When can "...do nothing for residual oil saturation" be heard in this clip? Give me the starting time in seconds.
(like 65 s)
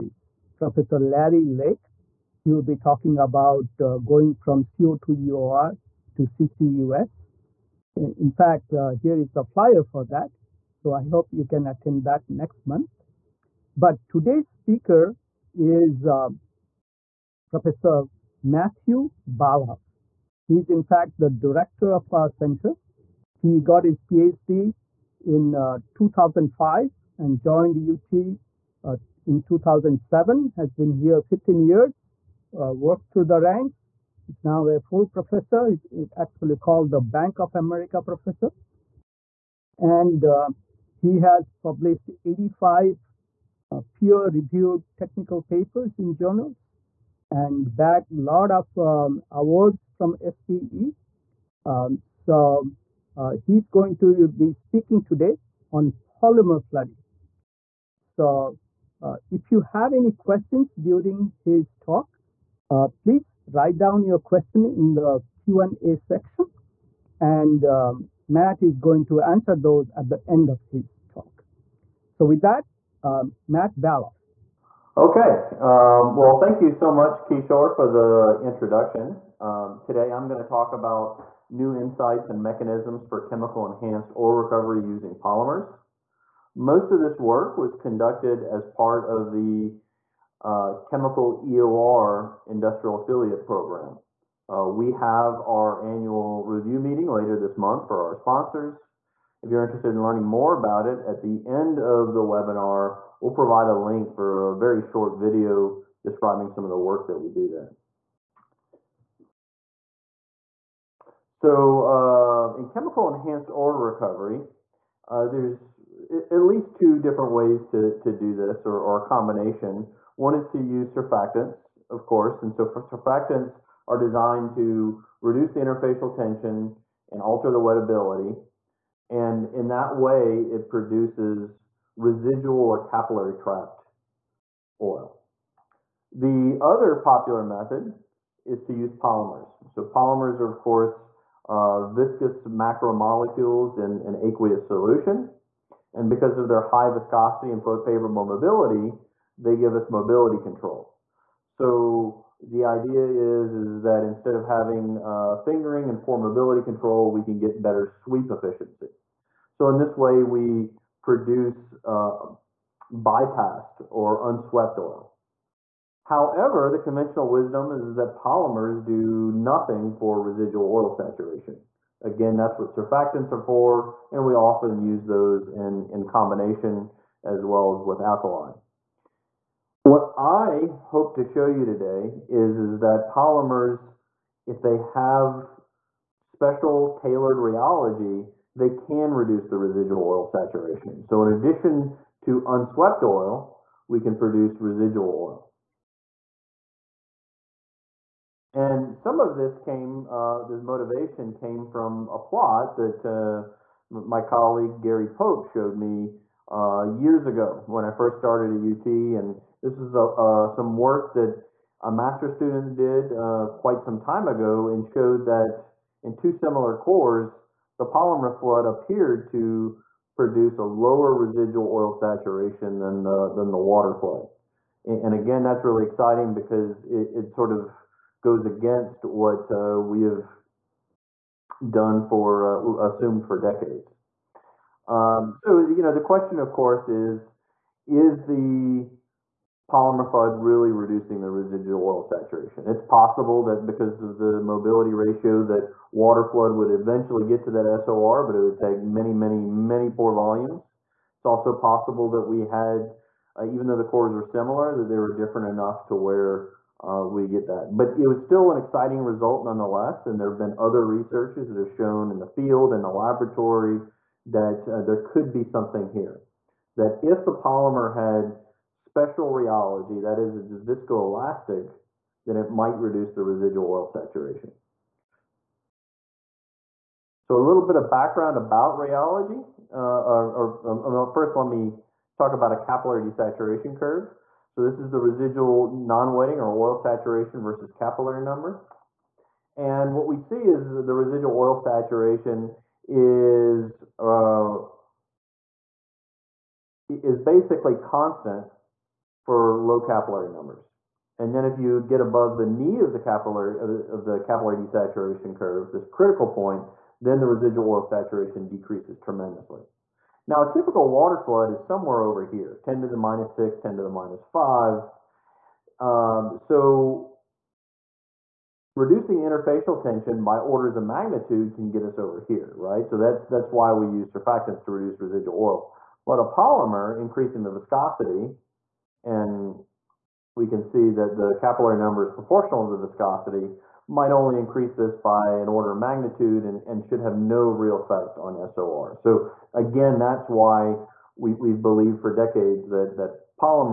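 168 s.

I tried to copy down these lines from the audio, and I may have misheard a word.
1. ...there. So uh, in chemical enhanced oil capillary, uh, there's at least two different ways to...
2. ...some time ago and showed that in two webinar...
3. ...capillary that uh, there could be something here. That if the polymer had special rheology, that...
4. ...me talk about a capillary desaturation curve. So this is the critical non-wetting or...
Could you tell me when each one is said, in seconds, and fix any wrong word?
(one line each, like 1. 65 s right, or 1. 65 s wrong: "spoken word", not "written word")
1. 107 s wrong: "recovery", not "capillary"
2. 213 s wrong: "similar", not "webinar"
3. 262 s wrong: "laboratory", not "capillary"
4. 281 s wrong: "residual", not "critical".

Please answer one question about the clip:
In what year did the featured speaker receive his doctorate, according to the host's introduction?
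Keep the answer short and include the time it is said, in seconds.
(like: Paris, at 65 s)
2005, at 25 s.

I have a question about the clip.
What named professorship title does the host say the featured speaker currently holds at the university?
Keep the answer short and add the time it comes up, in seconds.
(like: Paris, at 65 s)
Bank of America professor, at 37 s.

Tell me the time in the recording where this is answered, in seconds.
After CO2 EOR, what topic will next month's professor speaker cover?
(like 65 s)
6 s.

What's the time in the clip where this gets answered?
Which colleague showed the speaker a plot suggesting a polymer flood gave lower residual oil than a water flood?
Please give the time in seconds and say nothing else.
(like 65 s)
204 s.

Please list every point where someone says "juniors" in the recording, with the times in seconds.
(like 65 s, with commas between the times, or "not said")
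not said.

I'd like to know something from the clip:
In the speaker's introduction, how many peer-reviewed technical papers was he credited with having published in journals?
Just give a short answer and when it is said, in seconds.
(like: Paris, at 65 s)
85, at 42 s.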